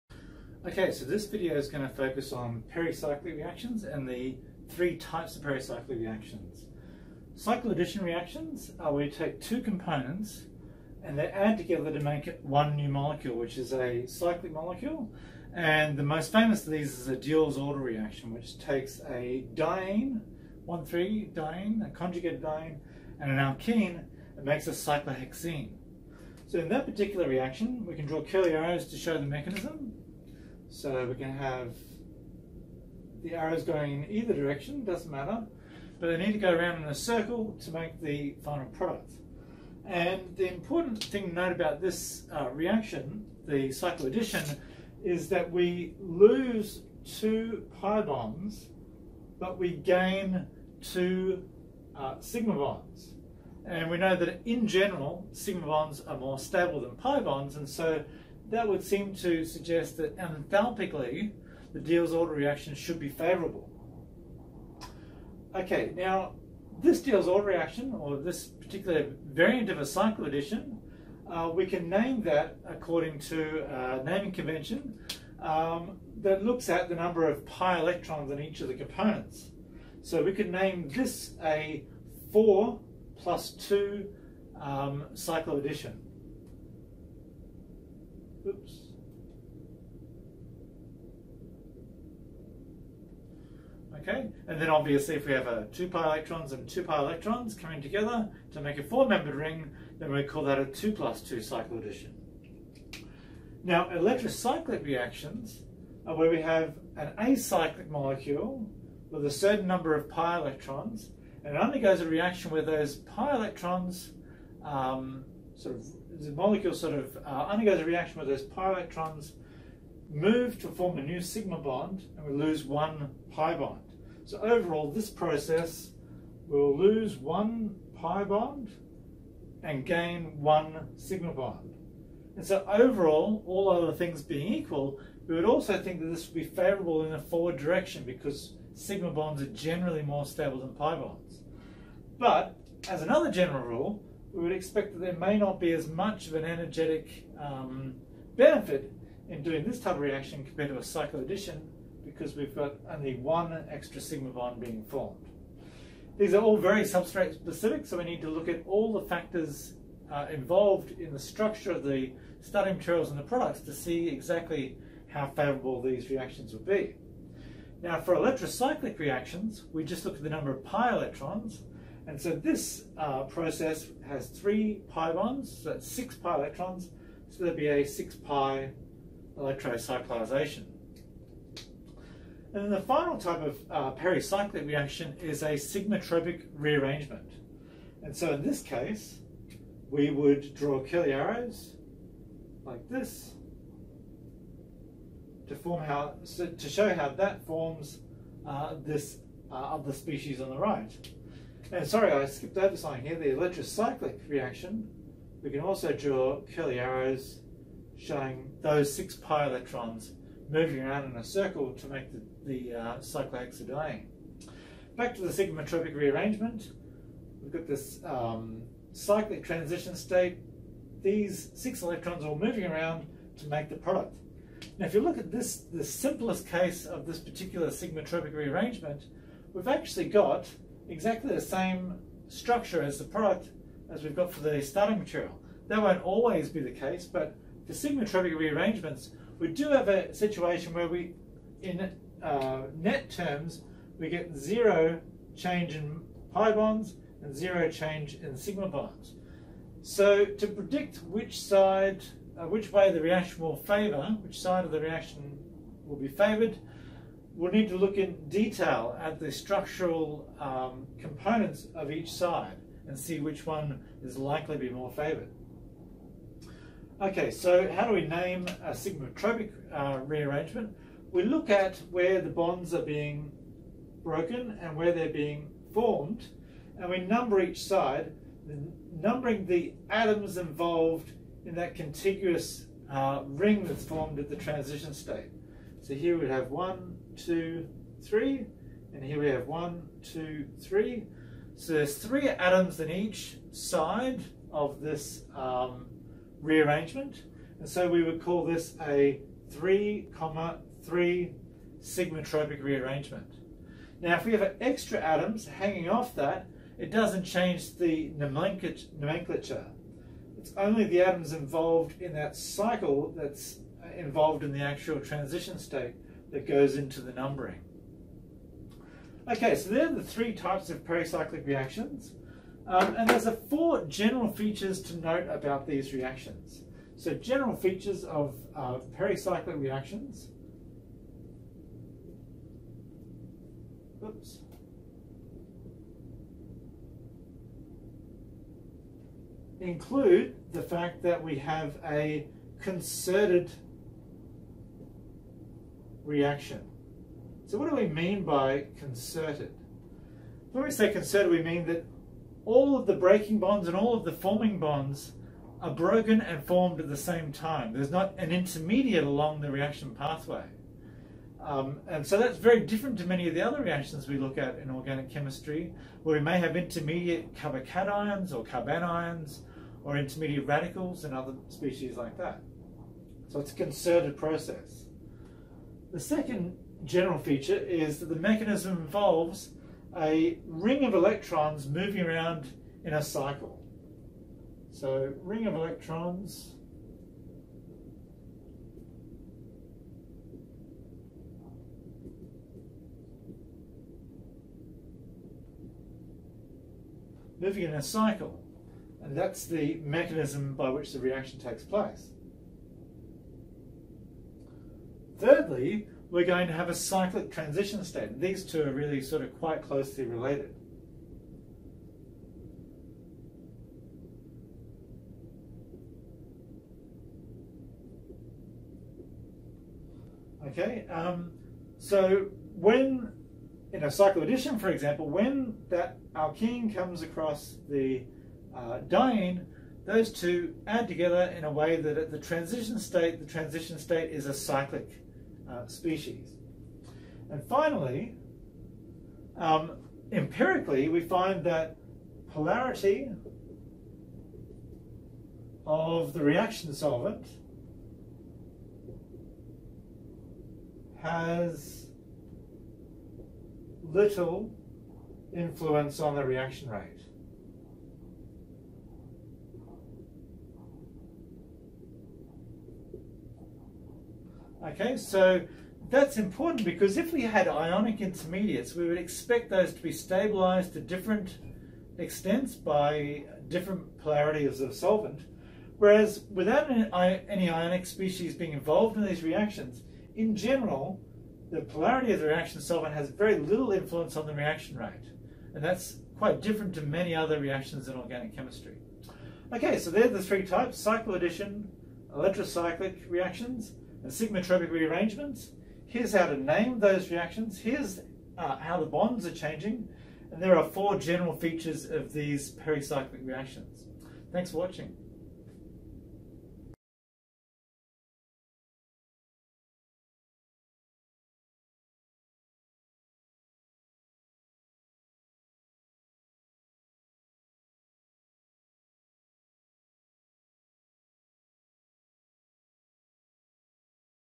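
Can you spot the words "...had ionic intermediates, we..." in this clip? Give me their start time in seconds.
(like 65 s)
467 s.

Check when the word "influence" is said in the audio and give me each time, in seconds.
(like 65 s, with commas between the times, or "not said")
455 s, 483 s.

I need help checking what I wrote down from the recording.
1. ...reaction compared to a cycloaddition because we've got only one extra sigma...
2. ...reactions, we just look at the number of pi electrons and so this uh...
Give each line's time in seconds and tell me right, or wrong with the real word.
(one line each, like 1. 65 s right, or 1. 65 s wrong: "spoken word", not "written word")
1. 150 s right
2. 168 s right.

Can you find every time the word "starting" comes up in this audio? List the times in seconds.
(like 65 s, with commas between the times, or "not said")
162 s, 234 s.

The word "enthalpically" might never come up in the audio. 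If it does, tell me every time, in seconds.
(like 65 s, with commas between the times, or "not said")
60 s.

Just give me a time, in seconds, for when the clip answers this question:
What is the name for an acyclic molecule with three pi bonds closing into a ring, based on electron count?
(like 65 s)
177 s.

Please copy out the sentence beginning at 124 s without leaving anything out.
So overall this process will lose one pi bond and gain one sigma bond.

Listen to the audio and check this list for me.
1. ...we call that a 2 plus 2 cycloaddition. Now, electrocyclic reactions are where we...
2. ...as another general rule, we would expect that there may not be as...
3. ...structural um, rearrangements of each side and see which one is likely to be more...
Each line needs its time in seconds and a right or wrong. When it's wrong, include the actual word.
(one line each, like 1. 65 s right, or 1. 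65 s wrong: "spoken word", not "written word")
1. 100 s right
2. 142 s right
3. 259 s wrong: "components", not "rearrangements".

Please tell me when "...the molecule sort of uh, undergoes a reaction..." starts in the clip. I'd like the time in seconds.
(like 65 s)
116 s.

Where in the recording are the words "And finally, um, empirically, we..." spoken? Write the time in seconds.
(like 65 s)
437 s.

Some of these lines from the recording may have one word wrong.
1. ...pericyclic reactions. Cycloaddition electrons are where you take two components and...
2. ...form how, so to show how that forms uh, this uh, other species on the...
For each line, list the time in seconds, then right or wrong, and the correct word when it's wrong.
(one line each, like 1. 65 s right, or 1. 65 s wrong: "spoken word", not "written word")
1. 5 s wrong: "reactions", not "electrons"
2. 195 s right.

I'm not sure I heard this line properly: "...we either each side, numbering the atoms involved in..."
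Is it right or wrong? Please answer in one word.
wrong.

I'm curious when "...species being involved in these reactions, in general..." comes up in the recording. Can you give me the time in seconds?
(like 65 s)
477 s.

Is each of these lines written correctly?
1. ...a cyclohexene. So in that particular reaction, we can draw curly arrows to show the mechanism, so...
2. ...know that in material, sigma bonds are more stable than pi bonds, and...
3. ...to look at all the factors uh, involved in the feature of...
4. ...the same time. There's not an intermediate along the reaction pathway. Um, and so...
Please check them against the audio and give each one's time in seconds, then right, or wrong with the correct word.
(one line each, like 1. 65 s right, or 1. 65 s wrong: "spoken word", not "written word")
1. 24 s right
2. 53 s wrong: "general", not "material"
3. 158 s wrong: "structure", not "feature"
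4. 356 s right.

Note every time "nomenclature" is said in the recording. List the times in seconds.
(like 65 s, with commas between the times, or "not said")
308 s.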